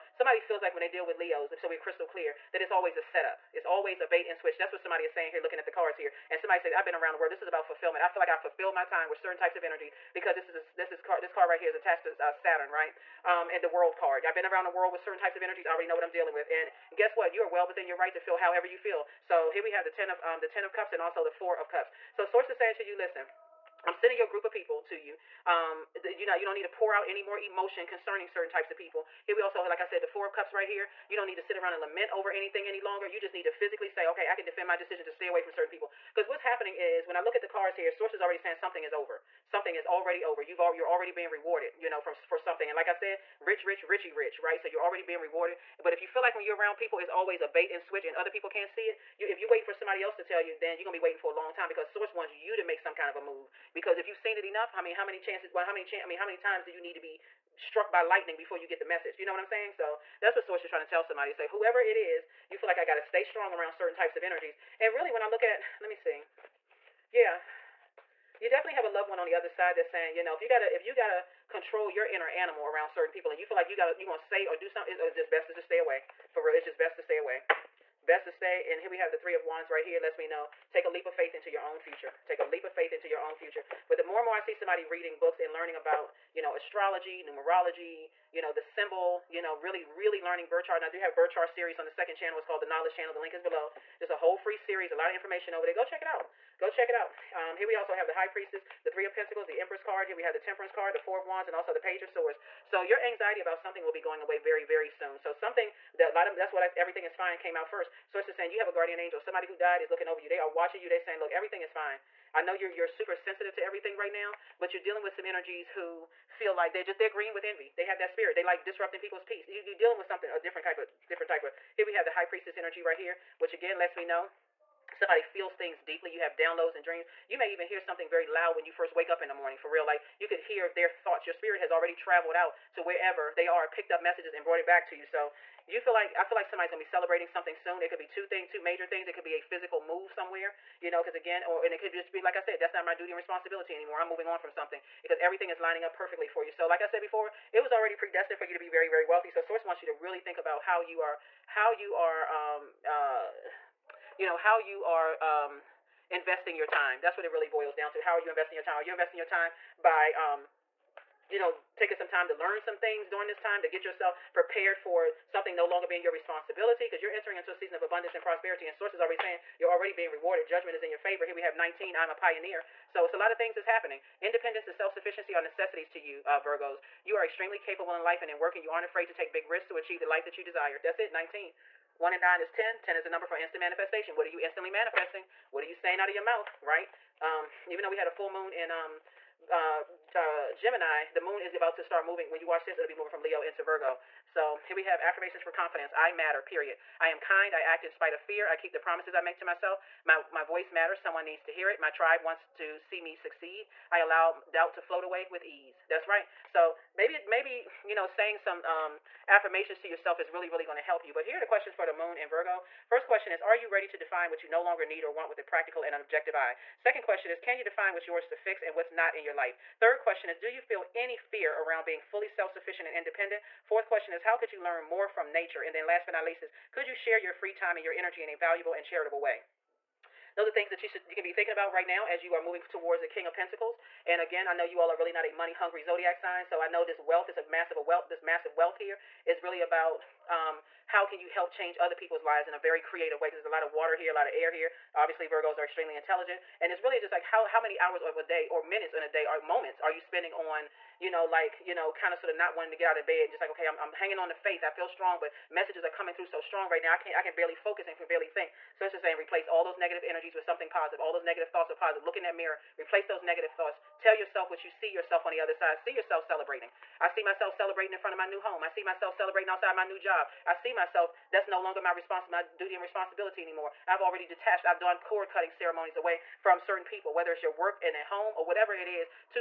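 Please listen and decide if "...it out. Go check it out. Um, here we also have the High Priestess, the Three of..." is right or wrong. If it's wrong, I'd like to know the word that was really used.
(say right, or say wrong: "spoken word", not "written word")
right.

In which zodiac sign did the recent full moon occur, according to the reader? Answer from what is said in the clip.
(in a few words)
Gemini.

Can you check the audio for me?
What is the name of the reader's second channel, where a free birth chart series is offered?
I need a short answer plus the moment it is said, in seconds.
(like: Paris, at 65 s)
the Knowledge Channel, at 92 s.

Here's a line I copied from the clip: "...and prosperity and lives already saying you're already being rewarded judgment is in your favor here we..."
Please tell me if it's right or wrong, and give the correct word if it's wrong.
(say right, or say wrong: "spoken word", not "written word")
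wrong: "sources", not "lives".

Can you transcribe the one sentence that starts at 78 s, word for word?
And here we have the three of wands right here.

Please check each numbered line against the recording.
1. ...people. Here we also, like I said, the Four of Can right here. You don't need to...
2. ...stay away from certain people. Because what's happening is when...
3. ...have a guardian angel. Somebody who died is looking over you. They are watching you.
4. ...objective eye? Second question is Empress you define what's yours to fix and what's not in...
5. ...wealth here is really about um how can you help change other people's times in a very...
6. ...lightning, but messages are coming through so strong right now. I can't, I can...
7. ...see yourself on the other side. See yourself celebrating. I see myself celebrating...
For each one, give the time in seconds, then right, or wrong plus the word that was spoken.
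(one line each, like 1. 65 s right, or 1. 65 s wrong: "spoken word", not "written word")
1. 28 s wrong: "Cups", not "Can"
2. 35 s right
3. 108 s right
4. 216 s wrong: "Can", not "Empress"
5. 238 s wrong: "lives", not "times"
6. 254 s wrong: "strong", not "lightning"
7. 264 s right.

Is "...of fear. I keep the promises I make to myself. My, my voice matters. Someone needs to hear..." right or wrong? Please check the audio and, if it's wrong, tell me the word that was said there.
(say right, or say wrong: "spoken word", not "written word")
right.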